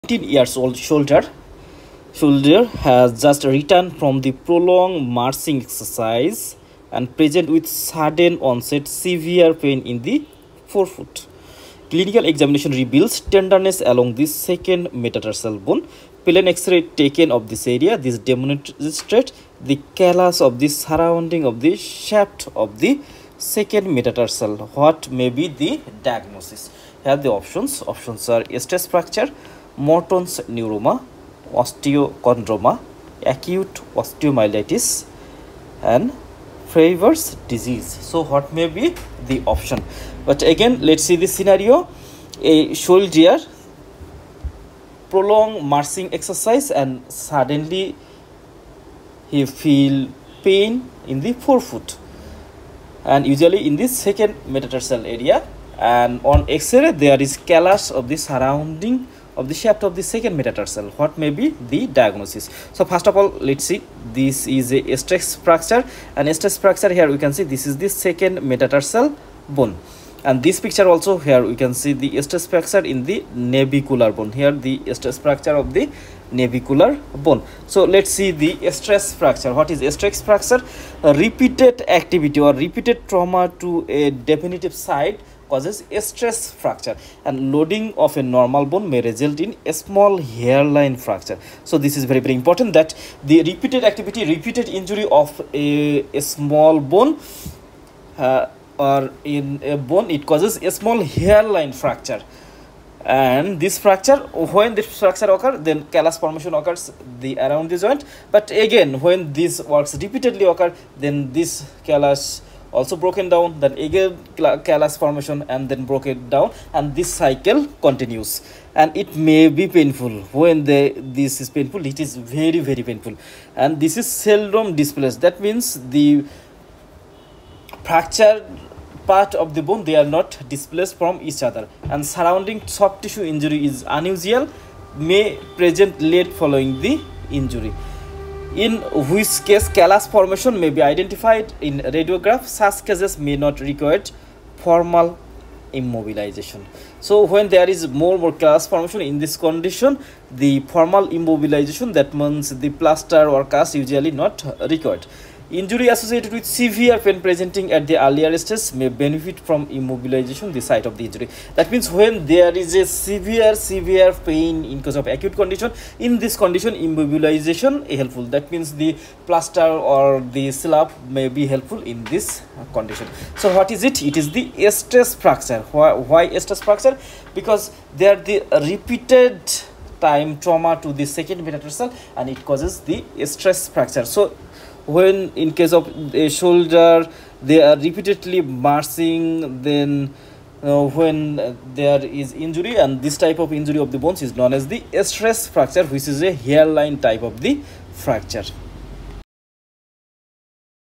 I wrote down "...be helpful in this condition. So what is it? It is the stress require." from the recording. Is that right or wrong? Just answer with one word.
wrong.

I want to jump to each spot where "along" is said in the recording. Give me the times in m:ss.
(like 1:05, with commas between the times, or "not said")
0:13.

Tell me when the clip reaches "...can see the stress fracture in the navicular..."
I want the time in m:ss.
1:11.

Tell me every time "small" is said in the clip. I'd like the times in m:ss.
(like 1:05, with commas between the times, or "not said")
1:29, 1:36, 1:40.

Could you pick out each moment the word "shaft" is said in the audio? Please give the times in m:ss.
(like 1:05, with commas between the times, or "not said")
0:21, 0:59.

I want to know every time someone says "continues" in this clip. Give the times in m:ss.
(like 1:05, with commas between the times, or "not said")
1:57.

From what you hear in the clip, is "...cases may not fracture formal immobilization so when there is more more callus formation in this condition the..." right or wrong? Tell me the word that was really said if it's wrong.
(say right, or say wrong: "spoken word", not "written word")
wrong: "require", not "fracture".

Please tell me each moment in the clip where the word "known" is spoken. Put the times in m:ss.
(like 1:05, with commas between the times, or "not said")
3:14.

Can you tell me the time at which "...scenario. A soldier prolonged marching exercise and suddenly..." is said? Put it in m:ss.
0:41.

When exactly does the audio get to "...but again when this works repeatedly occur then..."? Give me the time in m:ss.
1:48.